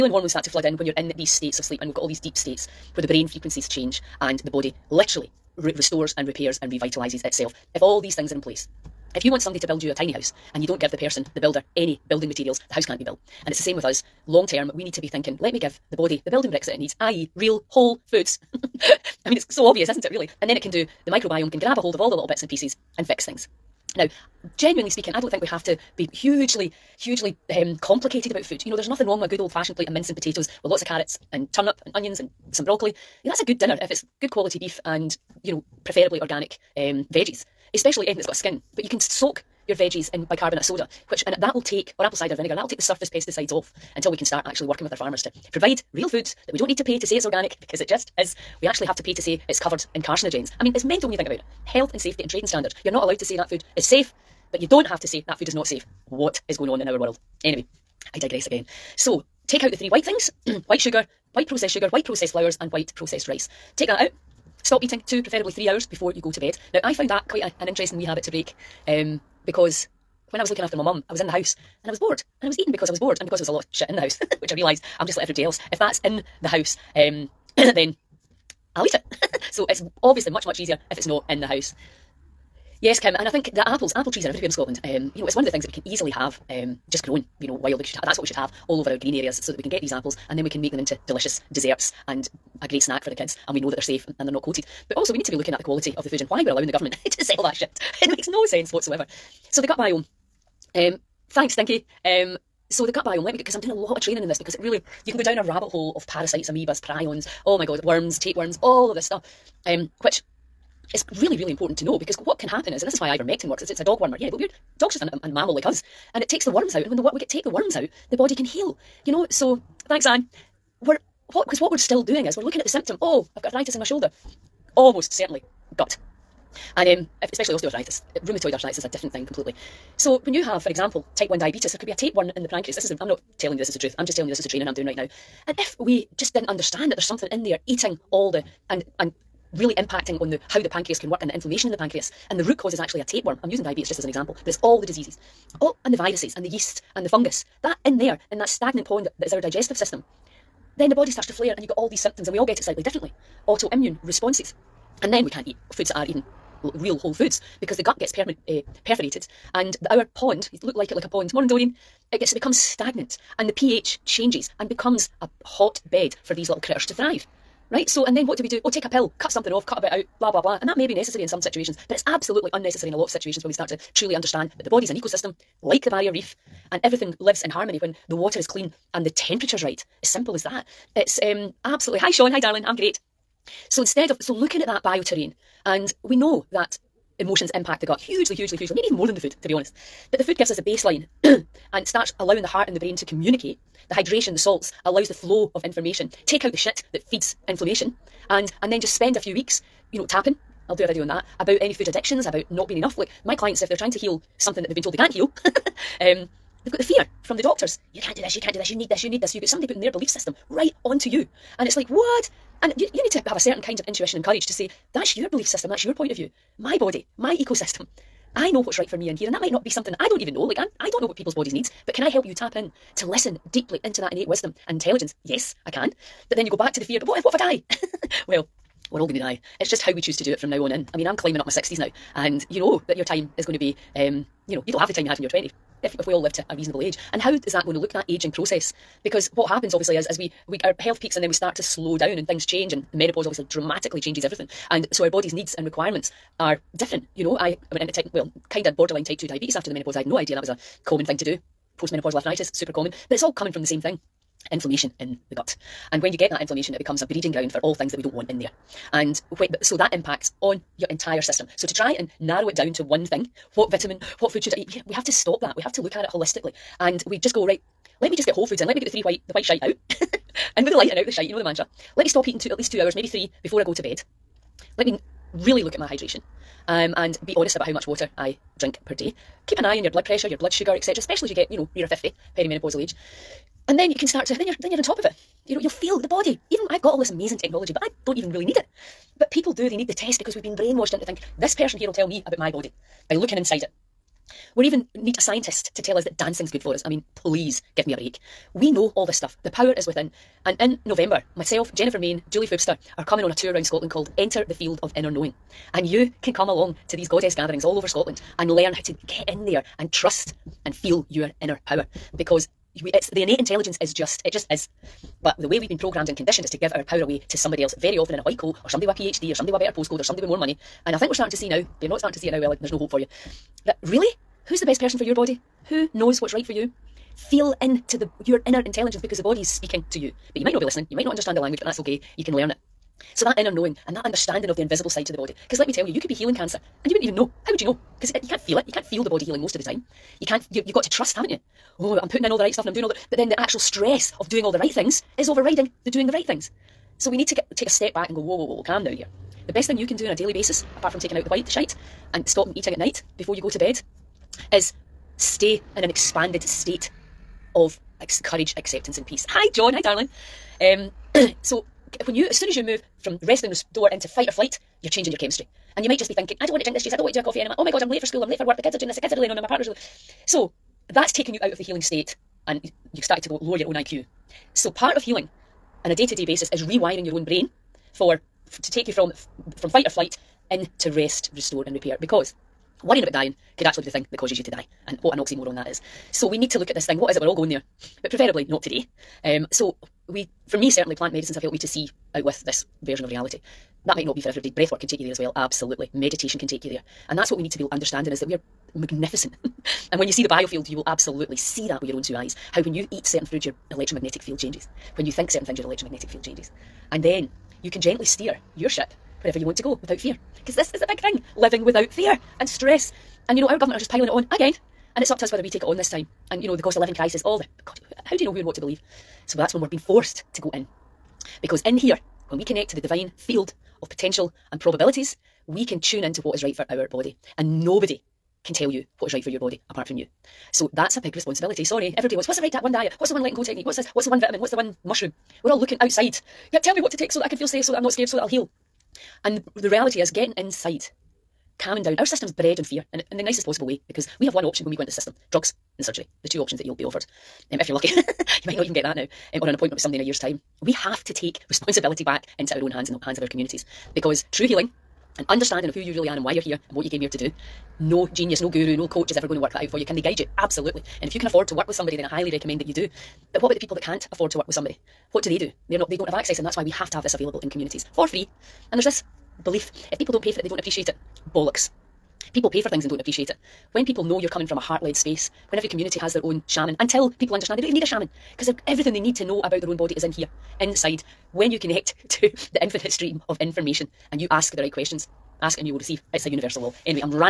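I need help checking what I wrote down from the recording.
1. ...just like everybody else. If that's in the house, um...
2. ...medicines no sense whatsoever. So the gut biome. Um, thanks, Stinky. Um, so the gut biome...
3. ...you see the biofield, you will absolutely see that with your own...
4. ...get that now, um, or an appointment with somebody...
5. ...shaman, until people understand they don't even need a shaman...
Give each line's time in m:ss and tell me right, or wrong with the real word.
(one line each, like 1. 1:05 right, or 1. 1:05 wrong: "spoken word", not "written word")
1. 1:15 right
2. 1:38 wrong: "makes", not "medicines"
3. 6:40 right
4. 7:28 right
5. 7:56 right.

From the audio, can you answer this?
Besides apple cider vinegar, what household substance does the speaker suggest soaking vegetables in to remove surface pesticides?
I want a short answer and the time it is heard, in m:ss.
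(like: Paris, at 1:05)
Bicarbonate of soda, at 0:40.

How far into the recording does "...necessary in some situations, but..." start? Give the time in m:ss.
2:50.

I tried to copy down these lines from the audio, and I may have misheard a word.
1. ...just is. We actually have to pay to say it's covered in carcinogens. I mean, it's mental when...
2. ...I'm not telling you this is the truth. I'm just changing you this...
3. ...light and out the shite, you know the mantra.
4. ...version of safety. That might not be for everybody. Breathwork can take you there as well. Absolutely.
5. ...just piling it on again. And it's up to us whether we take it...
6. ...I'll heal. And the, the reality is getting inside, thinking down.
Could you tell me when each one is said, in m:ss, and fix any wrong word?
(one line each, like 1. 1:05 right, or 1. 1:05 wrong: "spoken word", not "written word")
1. 0:47 right
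2. 2:13 wrong: "telling", not "changing"
3. 4:30 right
4. 6:32 wrong: "reality", not "safety"
5. 6:53 right
6. 7:18 wrong: "calming", not "thinking".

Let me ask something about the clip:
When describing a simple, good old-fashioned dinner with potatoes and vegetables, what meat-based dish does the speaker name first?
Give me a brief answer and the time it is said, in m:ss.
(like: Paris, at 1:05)
Mince, at 0:29.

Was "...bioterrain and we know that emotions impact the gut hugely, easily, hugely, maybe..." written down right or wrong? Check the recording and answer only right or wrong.
wrong.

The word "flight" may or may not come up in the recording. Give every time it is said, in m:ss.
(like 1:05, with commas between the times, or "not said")
6:04, 6:19.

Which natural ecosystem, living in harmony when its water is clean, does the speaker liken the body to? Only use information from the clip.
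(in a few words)
Barrier Reef.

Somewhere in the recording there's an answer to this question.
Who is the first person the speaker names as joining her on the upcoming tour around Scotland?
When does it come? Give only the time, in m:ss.
5:01.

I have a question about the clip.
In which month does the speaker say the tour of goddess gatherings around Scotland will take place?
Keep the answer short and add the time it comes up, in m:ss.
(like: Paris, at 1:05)
November, at 5:00.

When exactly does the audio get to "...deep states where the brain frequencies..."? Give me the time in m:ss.
0:02.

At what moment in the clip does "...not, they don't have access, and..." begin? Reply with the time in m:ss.
7:45.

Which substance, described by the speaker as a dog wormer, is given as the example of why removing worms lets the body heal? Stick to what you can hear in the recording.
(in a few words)
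Ivermectin.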